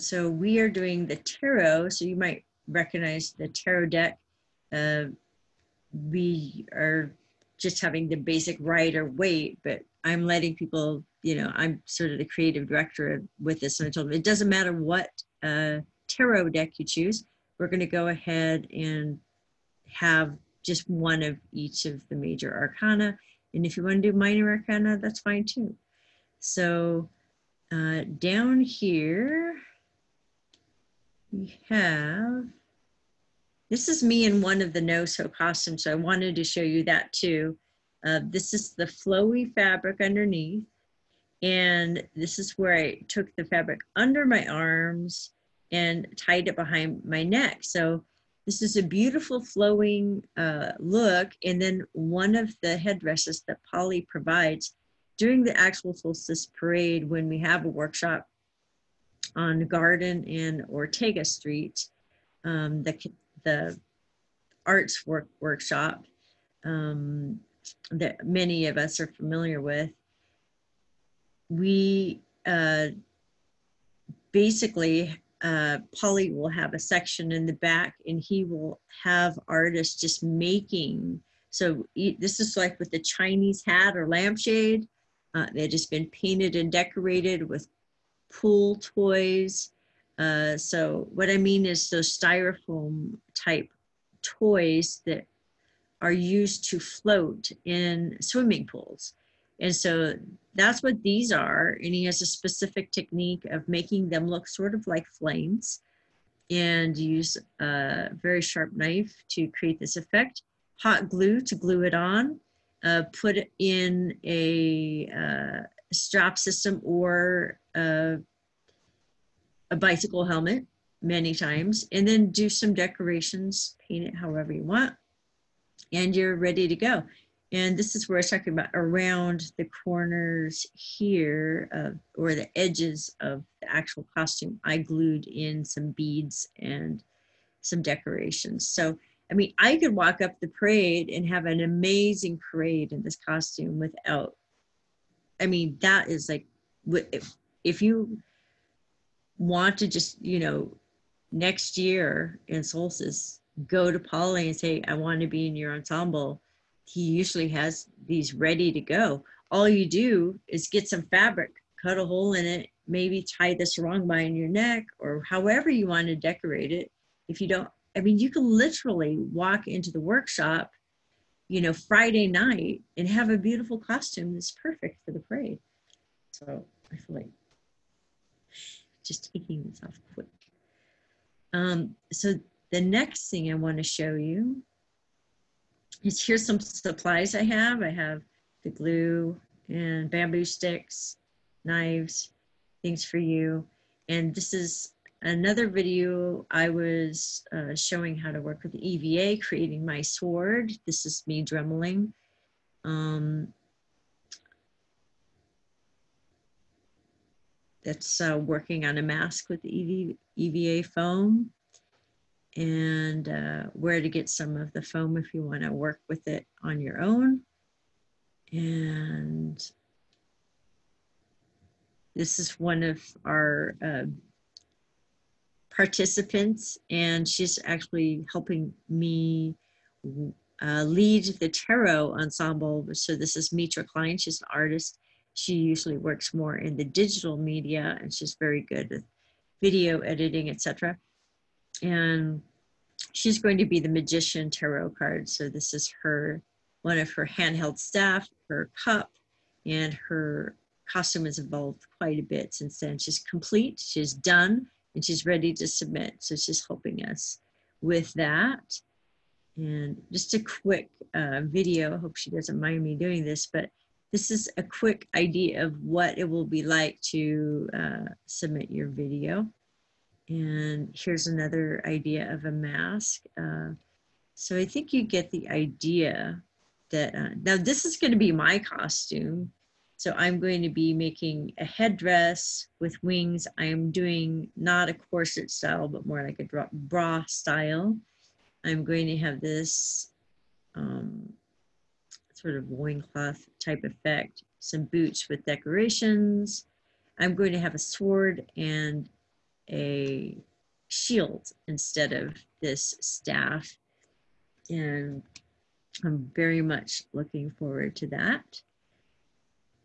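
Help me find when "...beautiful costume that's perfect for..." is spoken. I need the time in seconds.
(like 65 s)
173 s.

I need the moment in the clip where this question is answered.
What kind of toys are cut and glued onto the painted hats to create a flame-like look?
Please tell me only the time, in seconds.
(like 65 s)
88 s.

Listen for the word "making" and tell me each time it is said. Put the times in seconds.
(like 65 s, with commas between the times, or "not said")
80 s, 103 s, 280 s.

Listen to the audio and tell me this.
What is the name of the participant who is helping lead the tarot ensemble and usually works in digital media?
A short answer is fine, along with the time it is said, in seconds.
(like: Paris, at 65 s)
Mitra Klein, at 233 s.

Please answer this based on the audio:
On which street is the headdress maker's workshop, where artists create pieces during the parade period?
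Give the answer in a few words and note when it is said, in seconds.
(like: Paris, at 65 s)
Garden and Ortega Street, at 59 s.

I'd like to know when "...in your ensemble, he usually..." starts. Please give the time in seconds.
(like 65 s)
155 s.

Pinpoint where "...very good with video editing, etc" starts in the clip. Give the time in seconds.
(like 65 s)
238 s.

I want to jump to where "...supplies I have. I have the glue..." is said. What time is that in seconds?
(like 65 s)
186 s.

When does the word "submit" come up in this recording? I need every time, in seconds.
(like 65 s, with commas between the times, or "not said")
255 s, 268 s.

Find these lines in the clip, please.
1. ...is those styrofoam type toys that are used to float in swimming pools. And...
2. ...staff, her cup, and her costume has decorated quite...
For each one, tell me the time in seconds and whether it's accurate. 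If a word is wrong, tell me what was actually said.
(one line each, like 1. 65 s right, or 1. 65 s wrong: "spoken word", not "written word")
1. 91 s right
2. 247 s wrong: "evolved", not "decorated".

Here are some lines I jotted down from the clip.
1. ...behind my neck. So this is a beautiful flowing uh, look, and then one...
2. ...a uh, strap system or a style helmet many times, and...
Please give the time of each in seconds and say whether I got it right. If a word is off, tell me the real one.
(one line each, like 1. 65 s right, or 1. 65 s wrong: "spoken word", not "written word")
1. 46 s right
2. 114 s wrong: "bicycle", not "style".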